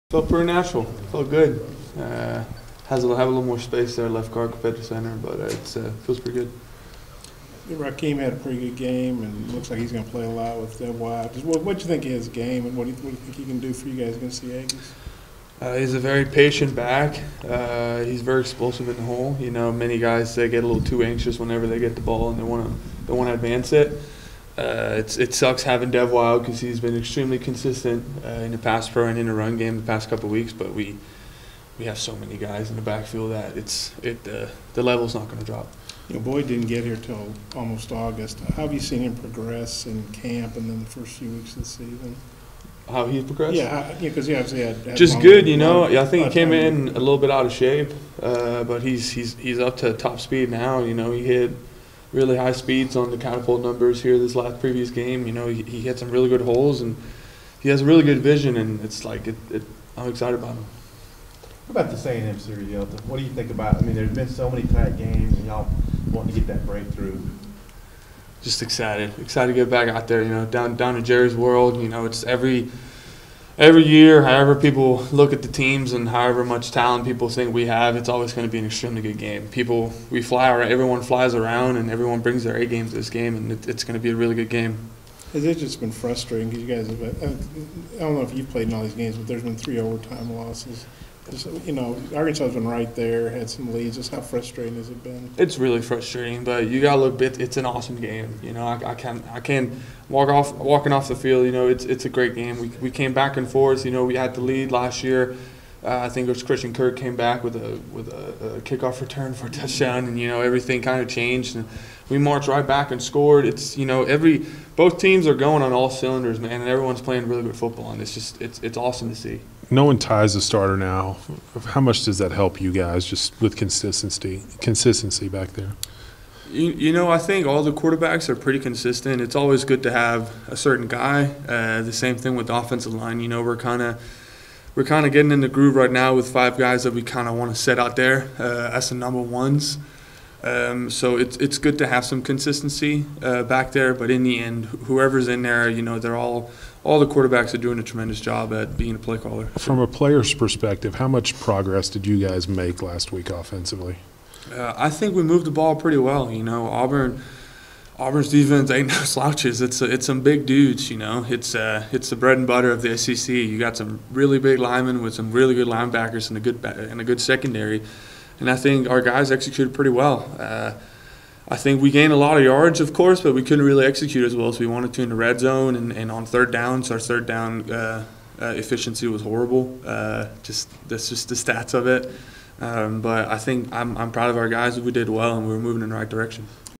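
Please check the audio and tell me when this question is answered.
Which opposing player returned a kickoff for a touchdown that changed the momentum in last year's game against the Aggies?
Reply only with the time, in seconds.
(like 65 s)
106 s.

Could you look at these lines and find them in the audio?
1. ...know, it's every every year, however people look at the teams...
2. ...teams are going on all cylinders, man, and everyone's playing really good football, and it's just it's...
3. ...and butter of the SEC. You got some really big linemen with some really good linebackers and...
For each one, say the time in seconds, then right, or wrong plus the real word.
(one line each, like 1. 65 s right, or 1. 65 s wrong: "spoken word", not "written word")
1. 71 s right
2. 114 s right
3. 162 s right.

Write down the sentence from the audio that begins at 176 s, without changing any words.
So our third down uh, uh, efficiency was horrible.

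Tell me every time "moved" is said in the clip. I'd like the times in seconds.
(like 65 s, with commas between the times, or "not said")
155 s.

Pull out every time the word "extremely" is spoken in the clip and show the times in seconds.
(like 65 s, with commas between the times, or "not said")
26 s, 78 s.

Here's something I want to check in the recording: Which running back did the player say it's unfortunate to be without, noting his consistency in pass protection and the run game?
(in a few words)
Devwah Whaley.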